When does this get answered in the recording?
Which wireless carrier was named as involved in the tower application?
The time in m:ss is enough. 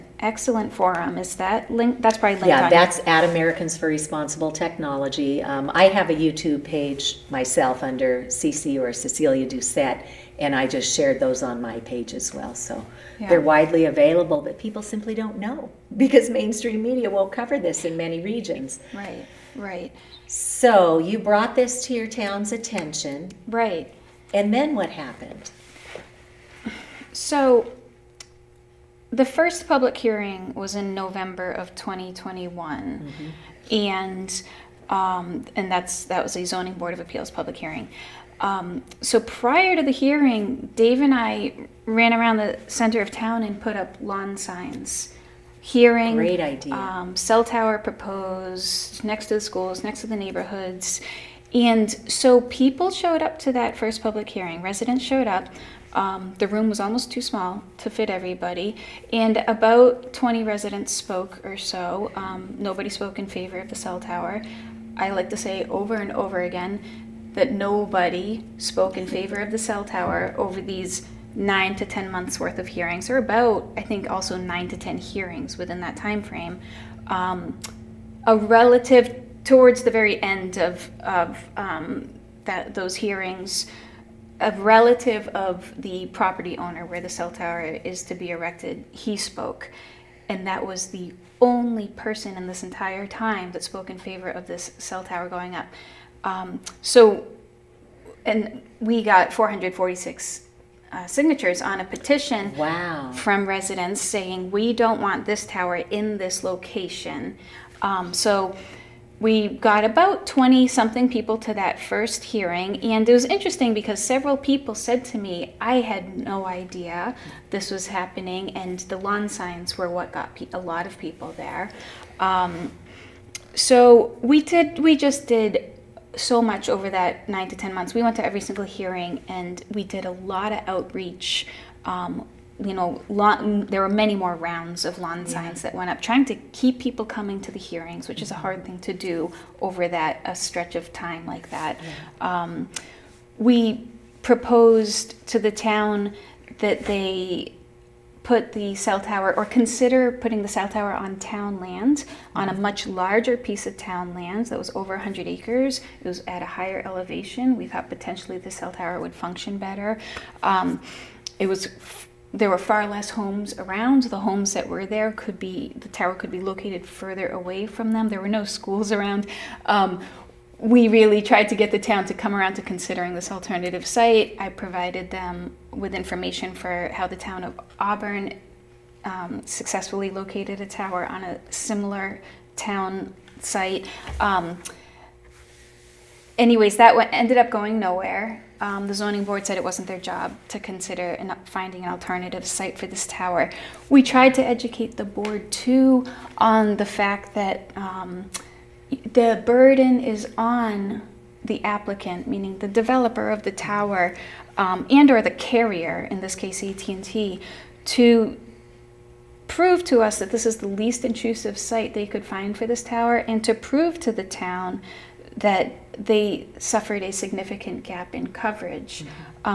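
3:26.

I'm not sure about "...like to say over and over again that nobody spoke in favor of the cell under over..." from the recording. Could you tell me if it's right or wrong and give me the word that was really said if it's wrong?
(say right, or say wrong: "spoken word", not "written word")
wrong: "tower", not "under".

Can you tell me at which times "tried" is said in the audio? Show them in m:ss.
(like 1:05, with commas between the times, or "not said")
2:51, 3:14.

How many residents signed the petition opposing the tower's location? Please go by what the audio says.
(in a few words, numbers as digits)
446.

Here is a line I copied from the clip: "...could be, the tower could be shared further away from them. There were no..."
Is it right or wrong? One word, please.
wrong.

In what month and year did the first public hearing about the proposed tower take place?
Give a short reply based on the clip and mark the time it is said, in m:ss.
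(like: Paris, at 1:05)
November 2021, at 0:30.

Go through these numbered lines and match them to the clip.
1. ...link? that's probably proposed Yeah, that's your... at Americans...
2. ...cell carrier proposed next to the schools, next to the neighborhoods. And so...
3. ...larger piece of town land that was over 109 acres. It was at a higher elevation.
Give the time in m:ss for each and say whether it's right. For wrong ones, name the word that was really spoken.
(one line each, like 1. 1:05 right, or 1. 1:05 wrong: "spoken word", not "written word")
1. 0:01 wrong: "linked", not "proposed"
2. 0:47 wrong: "tower", not "carrier"
3. 2:32 wrong: "100", not "109".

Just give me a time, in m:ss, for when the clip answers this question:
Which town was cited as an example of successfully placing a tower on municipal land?
2:57.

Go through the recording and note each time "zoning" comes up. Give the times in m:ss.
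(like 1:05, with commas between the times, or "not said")
0:36, 3:08.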